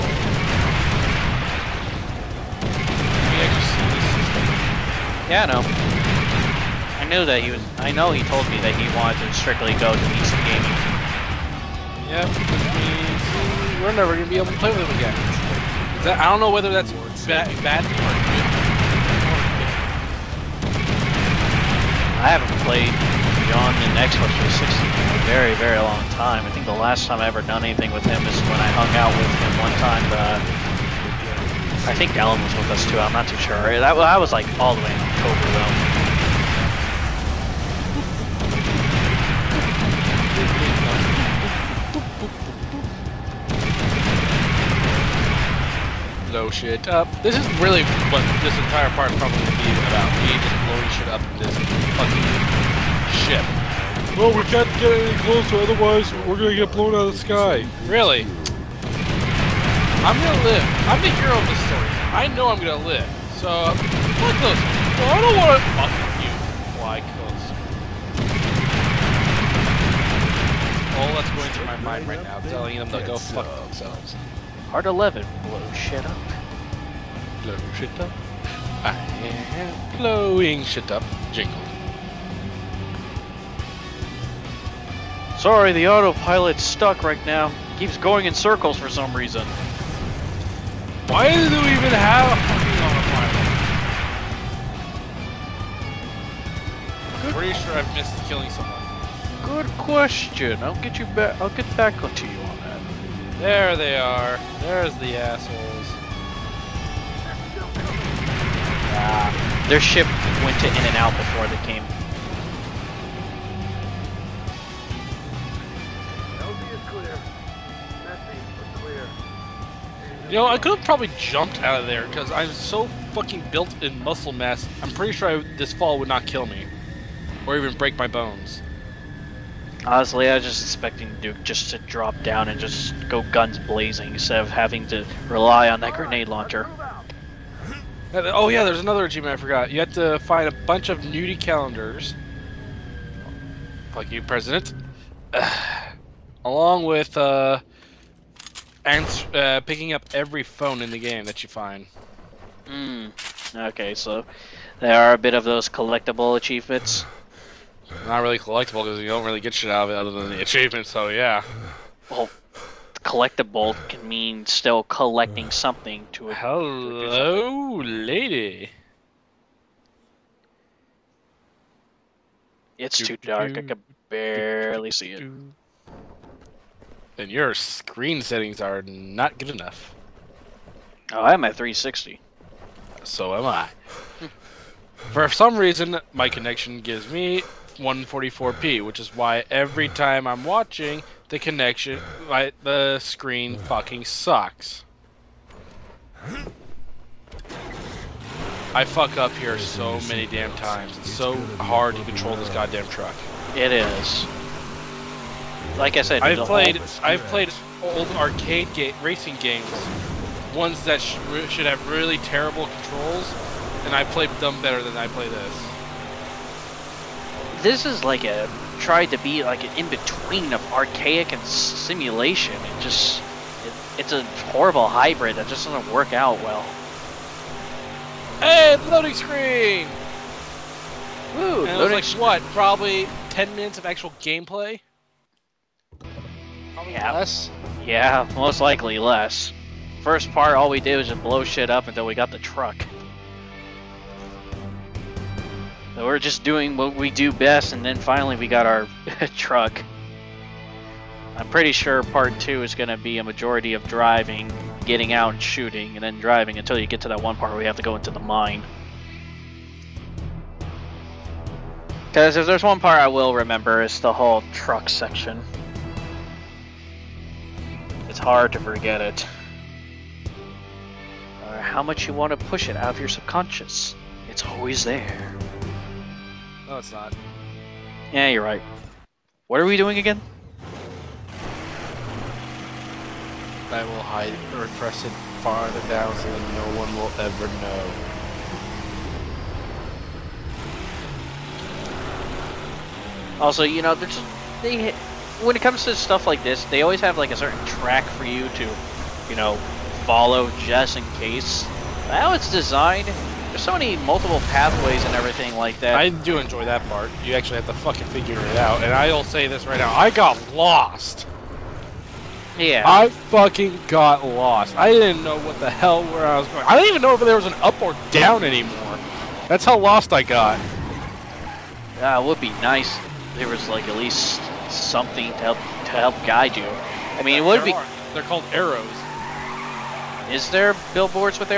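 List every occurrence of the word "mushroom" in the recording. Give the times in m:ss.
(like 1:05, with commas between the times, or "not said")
not said.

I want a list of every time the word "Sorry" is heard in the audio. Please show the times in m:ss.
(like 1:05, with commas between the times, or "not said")
1:25.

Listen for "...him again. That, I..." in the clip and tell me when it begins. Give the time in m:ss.
0:14.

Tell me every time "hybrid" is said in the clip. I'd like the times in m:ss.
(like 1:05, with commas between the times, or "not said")
3:44.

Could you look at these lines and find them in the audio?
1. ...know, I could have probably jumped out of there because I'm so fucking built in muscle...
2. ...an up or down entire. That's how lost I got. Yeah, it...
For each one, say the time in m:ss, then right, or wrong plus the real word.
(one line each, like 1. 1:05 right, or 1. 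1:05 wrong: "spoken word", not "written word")
1. 2:00 right
2. 5:17 wrong: "anymore", not "entire".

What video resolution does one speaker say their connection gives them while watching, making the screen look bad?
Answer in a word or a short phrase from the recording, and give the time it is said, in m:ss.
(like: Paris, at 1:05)
144p, at 3:07.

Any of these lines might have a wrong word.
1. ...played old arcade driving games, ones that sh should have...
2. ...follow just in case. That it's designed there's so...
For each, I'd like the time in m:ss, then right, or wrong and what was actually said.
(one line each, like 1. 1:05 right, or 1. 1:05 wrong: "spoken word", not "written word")
1. 3:27 wrong: "racing", not "driving"
2. 5:00 right.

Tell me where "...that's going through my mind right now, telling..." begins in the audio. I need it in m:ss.
1:11.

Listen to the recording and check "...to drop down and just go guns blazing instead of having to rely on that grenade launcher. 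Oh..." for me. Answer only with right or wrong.
right.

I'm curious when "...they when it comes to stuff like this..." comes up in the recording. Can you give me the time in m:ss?
4:54.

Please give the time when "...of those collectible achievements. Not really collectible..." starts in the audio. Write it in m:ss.
2:35.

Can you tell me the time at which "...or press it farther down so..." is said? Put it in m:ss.
4:44.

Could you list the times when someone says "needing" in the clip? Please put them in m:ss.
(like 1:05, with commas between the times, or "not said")
not said.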